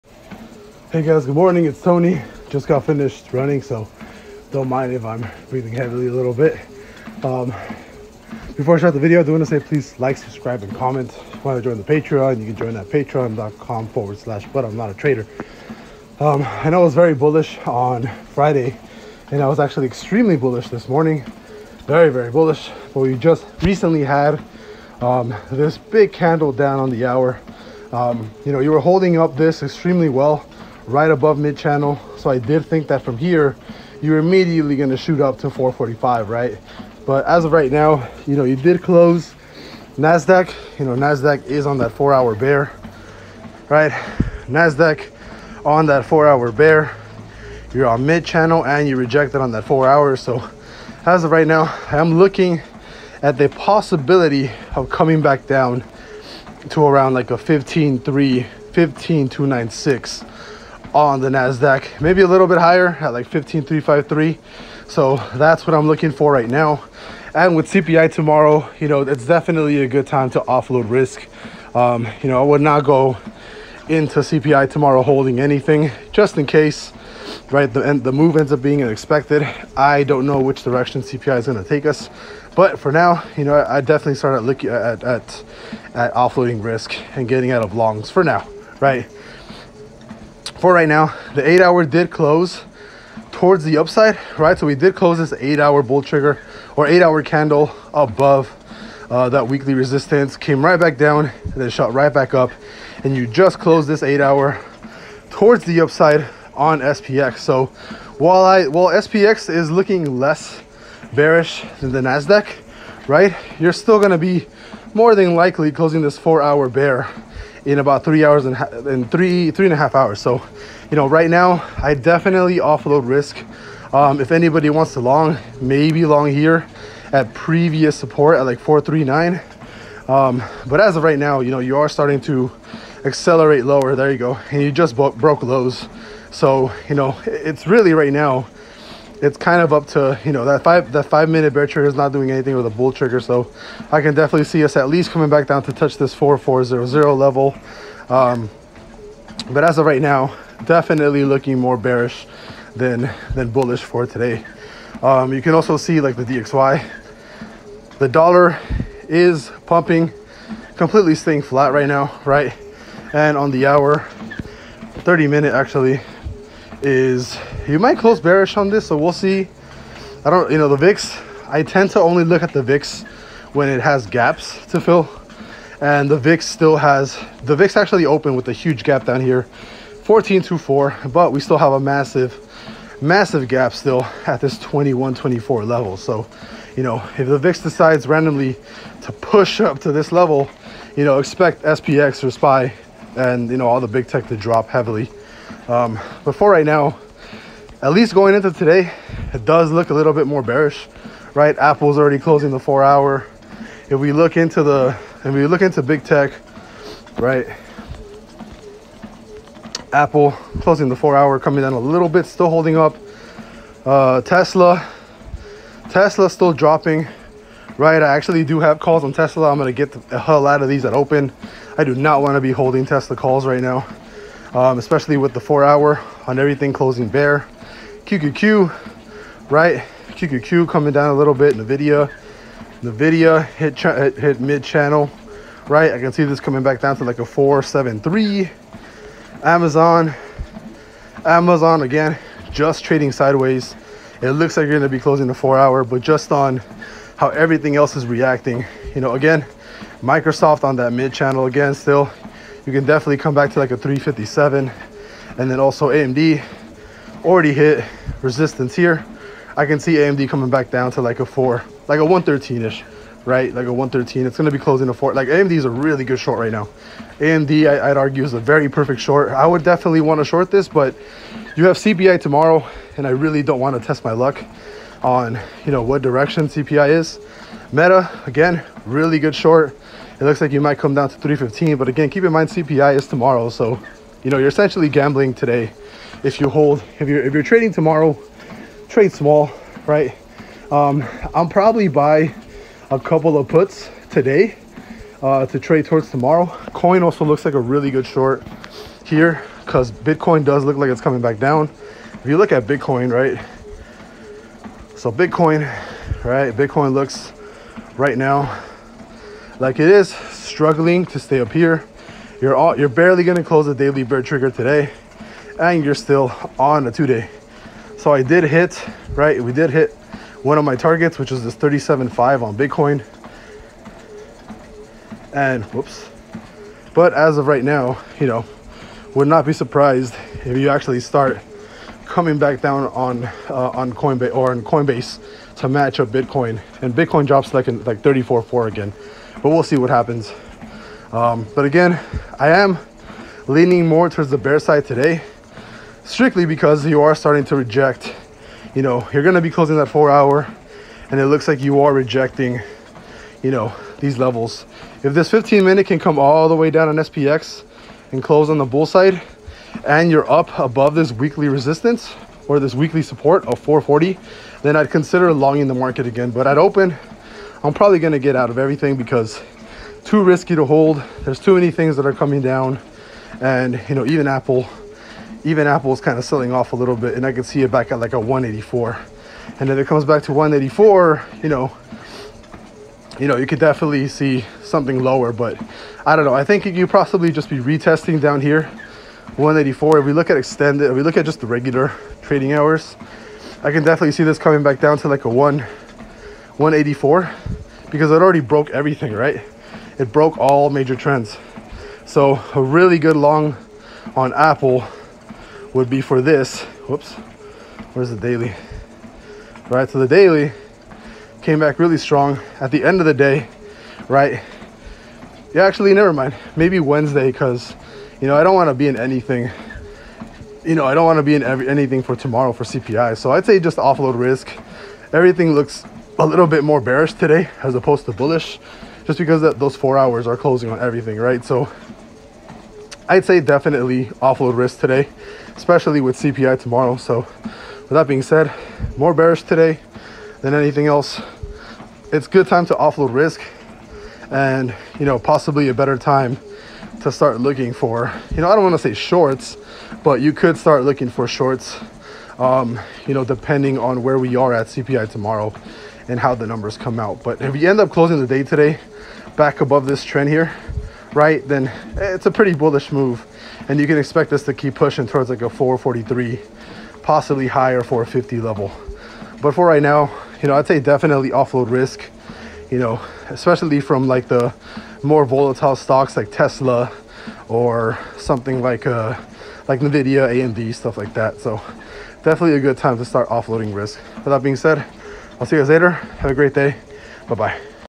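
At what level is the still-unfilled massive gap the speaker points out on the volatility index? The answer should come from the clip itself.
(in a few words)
21.24.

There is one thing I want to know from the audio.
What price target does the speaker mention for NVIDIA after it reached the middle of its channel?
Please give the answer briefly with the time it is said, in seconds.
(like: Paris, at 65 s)
473, at 237 s.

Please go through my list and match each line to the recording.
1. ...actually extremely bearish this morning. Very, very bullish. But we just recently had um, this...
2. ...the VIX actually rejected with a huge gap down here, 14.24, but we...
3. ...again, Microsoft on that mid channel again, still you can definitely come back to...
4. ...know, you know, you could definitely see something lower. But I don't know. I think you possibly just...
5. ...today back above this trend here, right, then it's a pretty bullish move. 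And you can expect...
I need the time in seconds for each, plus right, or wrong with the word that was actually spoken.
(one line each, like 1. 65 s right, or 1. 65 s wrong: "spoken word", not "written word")
1. 19 s wrong: "bullish", not "bearish"
2. 177 s wrong: "opened", not "rejected"
3. 249 s right
4. 381 s right
5. 458 s right.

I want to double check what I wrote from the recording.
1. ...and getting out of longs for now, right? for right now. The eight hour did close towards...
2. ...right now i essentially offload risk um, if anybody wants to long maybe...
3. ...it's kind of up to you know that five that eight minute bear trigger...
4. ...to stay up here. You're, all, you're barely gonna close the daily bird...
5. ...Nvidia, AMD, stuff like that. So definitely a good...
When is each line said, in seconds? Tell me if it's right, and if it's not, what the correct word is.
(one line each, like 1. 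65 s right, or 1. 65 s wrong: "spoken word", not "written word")
1. 87 s right
2. 121 s wrong: "definitely", not "essentially"
3. 139 s wrong: "five", not "eight"
4. 311 s right
5. 479 s right.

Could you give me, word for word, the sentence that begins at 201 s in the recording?
Apple's already closing the four hour.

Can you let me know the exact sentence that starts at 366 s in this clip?
But at open, I'm probably going to get out of everything because too risky to hold.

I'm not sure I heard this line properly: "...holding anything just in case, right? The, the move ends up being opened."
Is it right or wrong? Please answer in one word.
wrong.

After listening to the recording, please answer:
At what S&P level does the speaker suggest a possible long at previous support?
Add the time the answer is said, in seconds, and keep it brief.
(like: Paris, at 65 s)
439, at 128 s.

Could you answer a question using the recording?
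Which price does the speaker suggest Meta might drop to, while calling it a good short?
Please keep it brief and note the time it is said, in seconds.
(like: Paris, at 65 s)
315, at 281 s.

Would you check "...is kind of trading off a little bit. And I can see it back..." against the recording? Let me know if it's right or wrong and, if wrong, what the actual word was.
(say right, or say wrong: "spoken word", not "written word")
wrong: "selling", not "trading".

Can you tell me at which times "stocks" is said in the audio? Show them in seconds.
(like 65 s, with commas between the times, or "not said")
475 s.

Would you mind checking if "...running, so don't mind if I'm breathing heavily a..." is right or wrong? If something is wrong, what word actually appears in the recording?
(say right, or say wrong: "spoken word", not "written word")
right.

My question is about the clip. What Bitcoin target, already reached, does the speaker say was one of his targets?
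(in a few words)
37.5.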